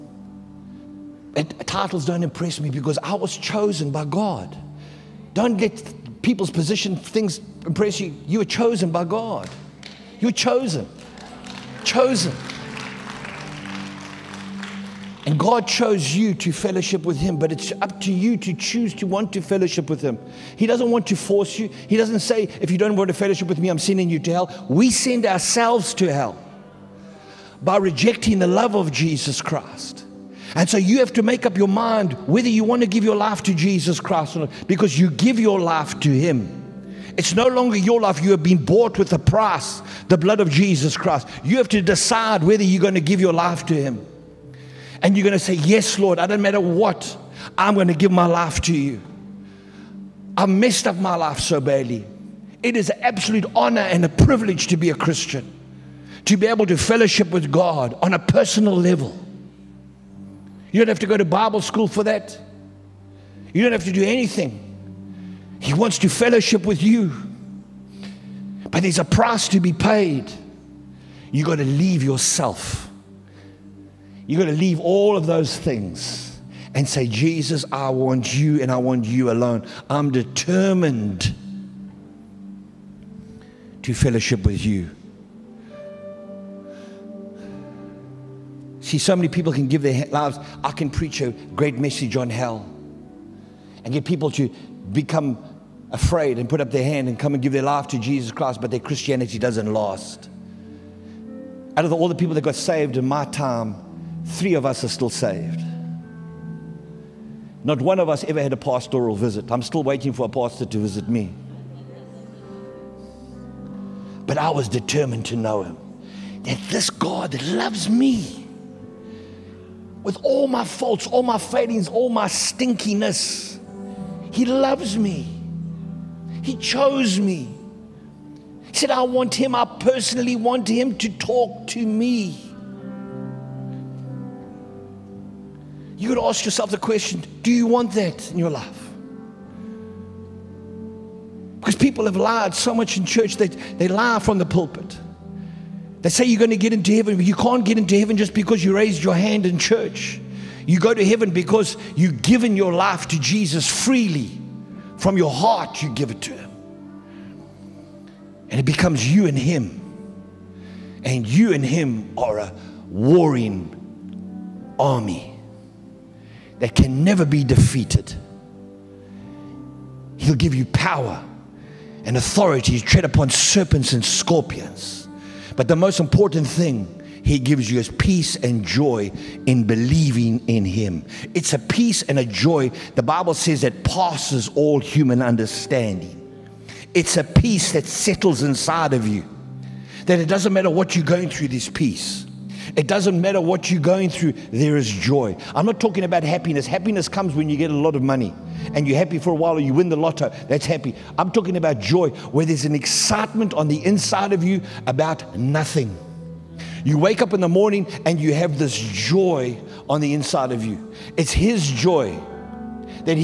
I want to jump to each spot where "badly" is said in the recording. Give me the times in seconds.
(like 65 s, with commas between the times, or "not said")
51 s.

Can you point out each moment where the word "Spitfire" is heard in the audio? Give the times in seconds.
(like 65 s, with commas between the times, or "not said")
not said.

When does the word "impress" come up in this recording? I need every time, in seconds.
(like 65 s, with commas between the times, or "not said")
2 s, 7 s.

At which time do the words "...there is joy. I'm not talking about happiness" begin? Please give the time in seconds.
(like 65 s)
194 s.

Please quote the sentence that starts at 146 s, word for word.
They say you're going to get into heaven, but you can't get into heaven just because you raised your hand in church.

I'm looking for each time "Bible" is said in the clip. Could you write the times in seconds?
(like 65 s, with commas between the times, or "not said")
61 s, 183 s.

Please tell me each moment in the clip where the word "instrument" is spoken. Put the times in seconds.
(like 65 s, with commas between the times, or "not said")
not said.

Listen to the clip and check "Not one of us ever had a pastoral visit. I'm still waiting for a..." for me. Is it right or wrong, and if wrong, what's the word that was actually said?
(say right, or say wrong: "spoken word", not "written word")
right.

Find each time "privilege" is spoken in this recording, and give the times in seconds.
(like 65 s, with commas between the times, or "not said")
54 s.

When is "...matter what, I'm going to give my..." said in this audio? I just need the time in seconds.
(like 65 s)
46 s.